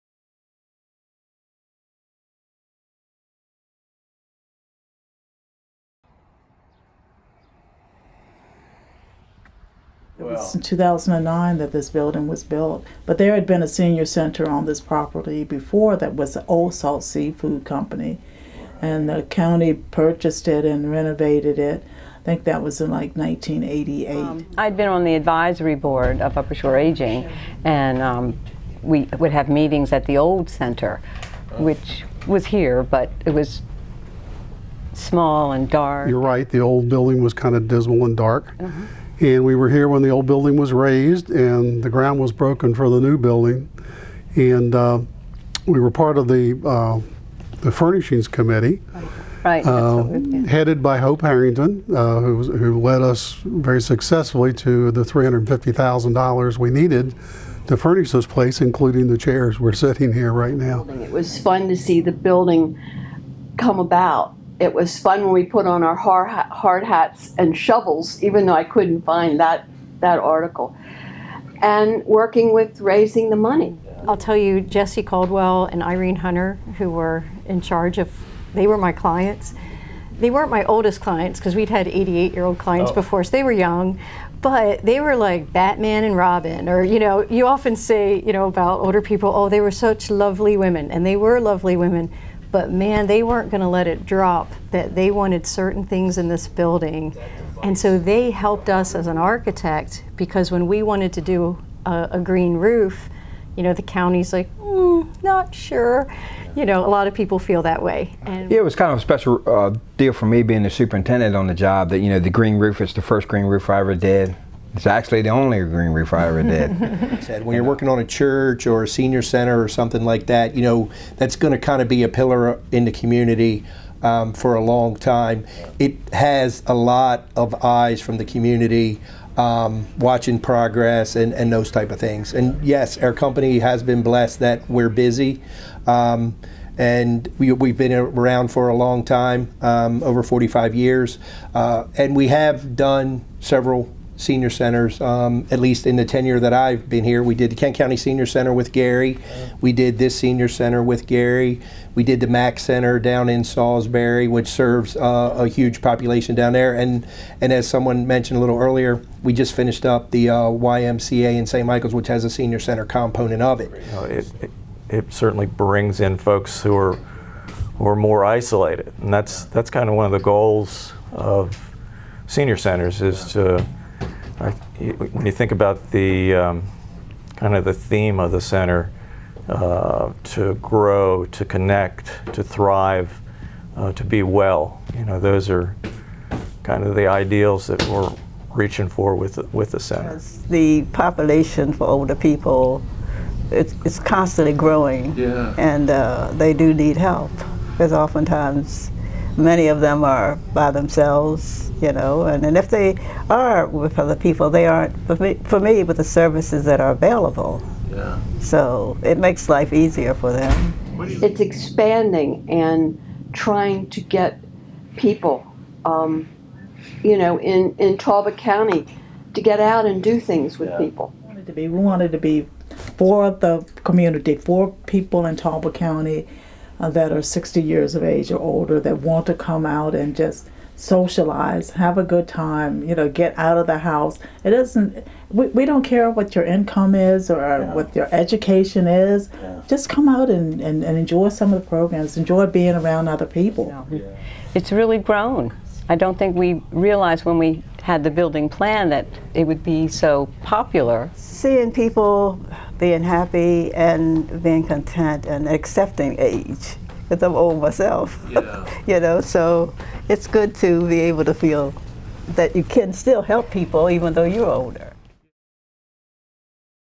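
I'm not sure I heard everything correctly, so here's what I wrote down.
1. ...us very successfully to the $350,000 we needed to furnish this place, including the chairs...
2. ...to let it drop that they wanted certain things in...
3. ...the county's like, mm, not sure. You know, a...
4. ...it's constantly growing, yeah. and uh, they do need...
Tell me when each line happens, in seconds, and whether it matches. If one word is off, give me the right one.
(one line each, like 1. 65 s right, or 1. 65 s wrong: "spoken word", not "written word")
1. 53 s right
2. 93 s right
3. 103 s right
4. 193 s right.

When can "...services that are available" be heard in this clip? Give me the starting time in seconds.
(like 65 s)
206 s.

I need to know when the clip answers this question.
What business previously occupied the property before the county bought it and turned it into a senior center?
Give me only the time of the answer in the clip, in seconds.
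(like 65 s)
16 s.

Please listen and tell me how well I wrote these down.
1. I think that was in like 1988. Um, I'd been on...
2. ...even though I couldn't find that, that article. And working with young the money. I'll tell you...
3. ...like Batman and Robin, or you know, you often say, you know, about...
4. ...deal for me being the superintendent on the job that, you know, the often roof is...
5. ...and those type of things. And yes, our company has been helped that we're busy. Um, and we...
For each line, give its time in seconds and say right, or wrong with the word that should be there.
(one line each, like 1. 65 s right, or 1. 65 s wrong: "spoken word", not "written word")
1. 22 s right
2. 68 s wrong: "raising", not "young"
3. 85 s right
4. 109 s wrong: "green", not "often"
5. 131 s wrong: "blessed", not "helped".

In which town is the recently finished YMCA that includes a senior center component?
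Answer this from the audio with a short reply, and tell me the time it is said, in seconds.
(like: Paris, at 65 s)
St. Michael's, at 161 s.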